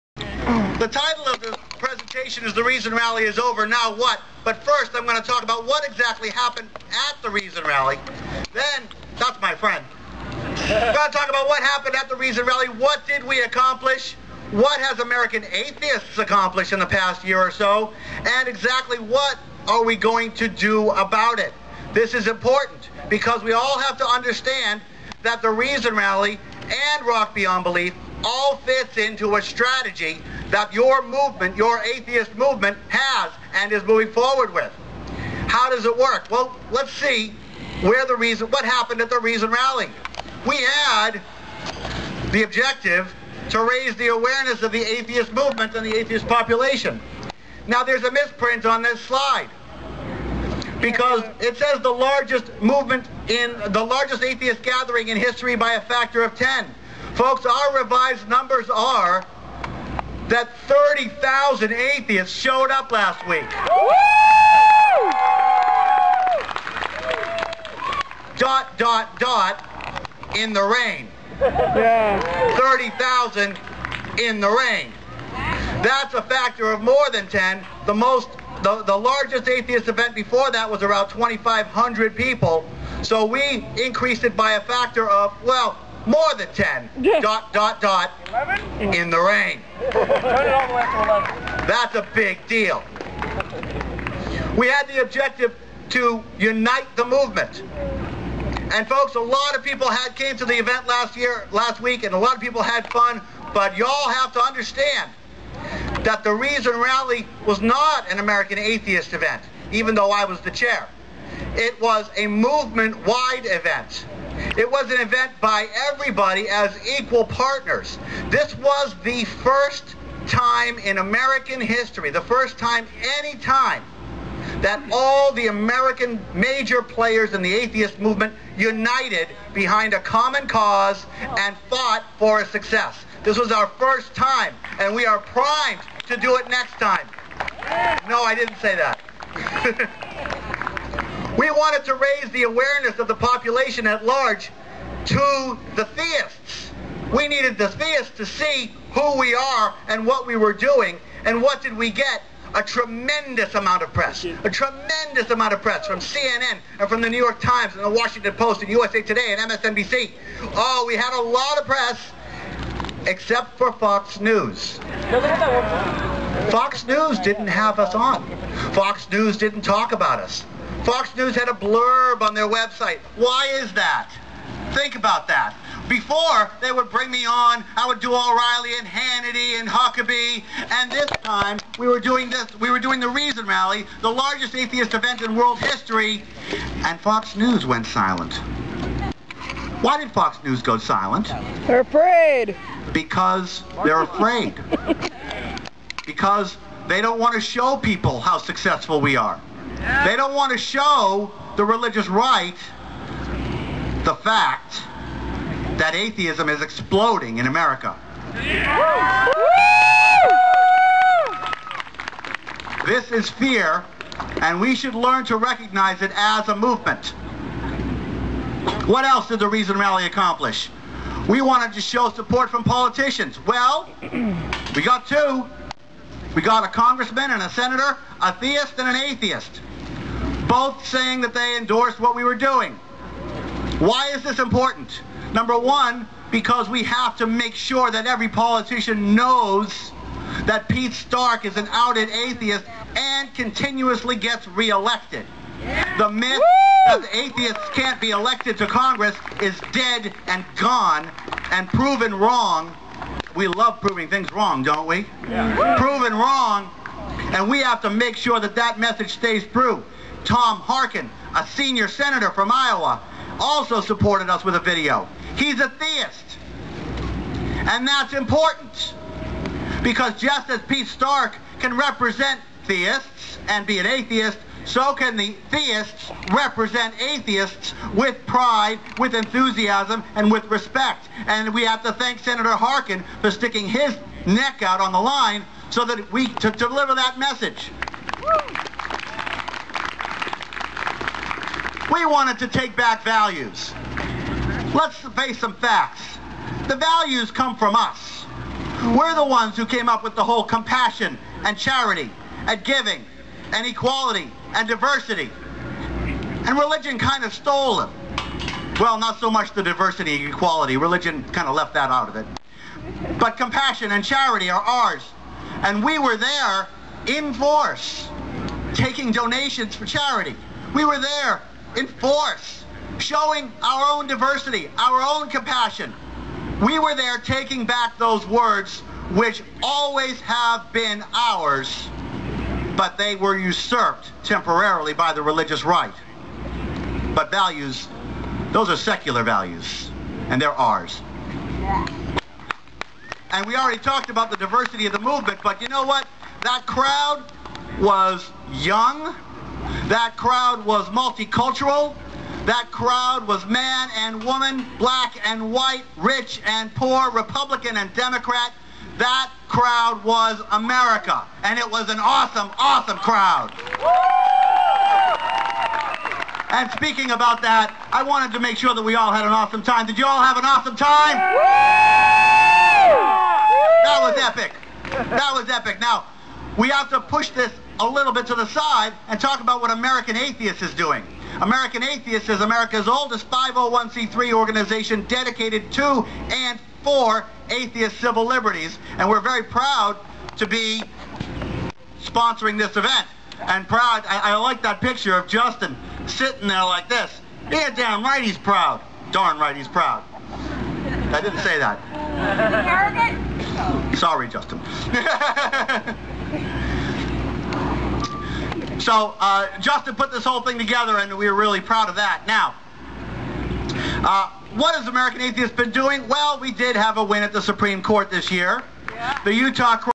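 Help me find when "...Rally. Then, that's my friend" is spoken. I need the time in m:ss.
0:07.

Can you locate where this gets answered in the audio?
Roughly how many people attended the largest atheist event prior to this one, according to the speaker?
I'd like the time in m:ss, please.
1:21.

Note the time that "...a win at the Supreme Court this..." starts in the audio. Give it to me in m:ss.
6:56.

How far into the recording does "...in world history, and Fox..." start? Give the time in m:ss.
3:05.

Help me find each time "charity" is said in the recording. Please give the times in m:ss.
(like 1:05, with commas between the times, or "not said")
5:01, 5:14, 5:19.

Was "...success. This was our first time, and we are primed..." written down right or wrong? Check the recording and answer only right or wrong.
right.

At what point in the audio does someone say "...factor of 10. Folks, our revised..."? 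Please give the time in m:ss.
0:55.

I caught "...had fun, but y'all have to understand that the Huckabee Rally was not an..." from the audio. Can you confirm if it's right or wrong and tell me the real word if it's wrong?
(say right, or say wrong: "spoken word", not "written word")
wrong: "Reason", not "Huckabee".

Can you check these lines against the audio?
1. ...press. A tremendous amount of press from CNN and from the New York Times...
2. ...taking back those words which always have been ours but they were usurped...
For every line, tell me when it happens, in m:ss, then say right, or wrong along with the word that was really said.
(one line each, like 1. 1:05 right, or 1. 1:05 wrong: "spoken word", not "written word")
1. 2:33 right
2. 5:27 right.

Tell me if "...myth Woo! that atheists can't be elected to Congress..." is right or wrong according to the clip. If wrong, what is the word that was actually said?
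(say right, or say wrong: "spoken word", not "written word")
right.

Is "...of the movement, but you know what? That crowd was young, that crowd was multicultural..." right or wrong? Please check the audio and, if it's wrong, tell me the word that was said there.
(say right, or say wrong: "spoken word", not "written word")
right.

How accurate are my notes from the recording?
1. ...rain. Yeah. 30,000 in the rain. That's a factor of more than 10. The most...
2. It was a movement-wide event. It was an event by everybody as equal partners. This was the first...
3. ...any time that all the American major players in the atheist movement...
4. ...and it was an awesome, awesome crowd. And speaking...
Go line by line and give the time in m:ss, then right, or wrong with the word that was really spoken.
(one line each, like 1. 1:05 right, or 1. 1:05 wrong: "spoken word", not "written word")
1. 1:10 right
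2. 1:51 right
3. 2:03 right
4. 6:01 right.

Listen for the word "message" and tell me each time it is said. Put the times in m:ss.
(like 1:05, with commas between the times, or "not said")
4:18, 4:47.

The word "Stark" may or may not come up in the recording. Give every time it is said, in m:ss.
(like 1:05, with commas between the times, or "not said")
4:00, 4:30.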